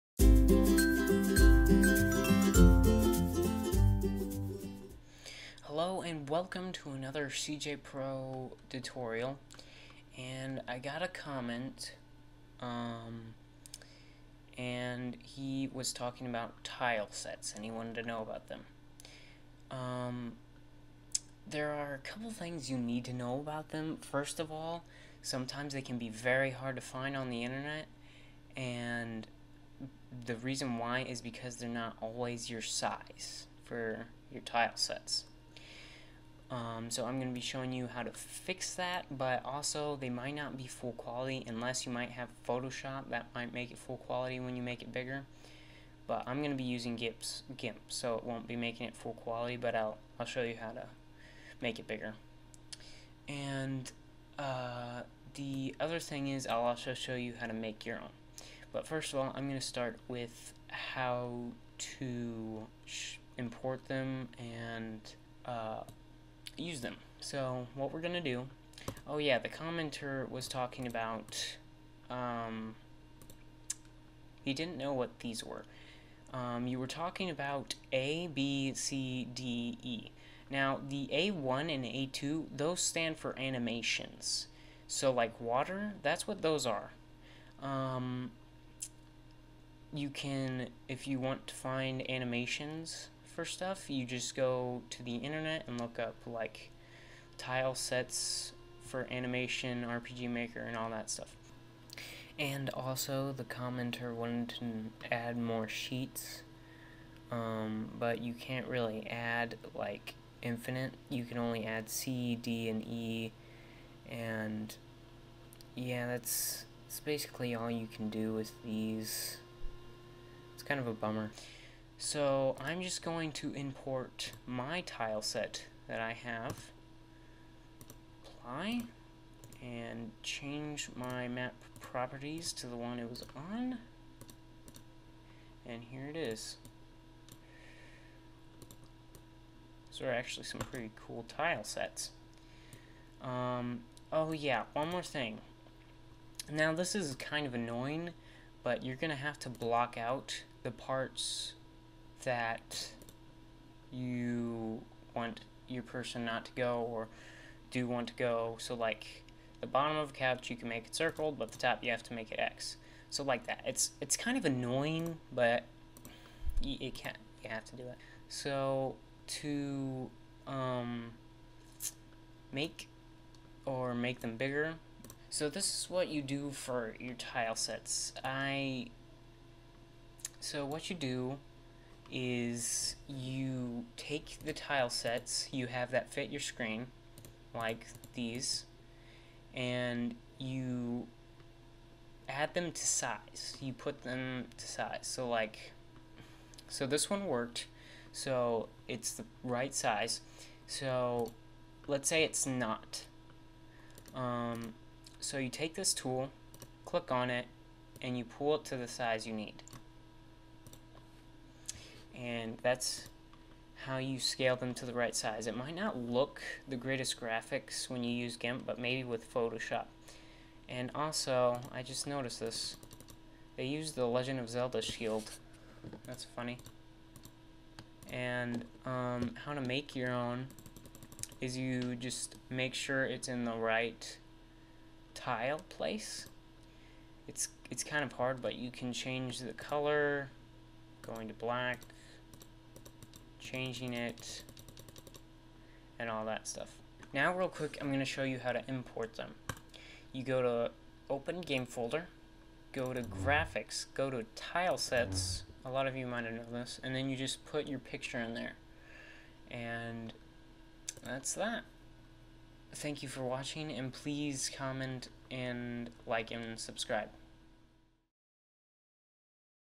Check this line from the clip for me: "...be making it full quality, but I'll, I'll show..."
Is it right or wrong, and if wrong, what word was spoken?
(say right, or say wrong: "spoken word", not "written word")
right.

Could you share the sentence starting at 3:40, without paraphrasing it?
And also, I just noticed this.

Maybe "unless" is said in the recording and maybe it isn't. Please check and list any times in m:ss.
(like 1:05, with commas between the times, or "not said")
0:41.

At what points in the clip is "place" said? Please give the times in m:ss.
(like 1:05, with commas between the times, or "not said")
3:55.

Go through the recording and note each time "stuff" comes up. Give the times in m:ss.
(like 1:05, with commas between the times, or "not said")
1:33, 1:41, 4:06.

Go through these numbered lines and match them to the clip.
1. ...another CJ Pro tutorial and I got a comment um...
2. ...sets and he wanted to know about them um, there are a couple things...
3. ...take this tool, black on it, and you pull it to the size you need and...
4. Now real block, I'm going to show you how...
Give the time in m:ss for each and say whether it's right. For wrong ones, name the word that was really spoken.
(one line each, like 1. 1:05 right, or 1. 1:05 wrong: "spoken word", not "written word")
1. 0:06 right
2. 0:17 right
3. 3:25 wrong: "click", not "black"
4. 4:07 wrong: "quick", not "block".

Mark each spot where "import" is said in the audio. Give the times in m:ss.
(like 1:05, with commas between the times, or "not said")
1:03, 2:03, 4:08.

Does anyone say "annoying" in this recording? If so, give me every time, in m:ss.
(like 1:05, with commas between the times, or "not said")
2:27, 2:44.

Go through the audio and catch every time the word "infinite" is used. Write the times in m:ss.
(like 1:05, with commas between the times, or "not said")
1:50.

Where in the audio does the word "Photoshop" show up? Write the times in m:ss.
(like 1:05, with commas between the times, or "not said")
0:42, 3:39.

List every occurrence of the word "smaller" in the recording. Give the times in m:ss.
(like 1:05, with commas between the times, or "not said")
not said.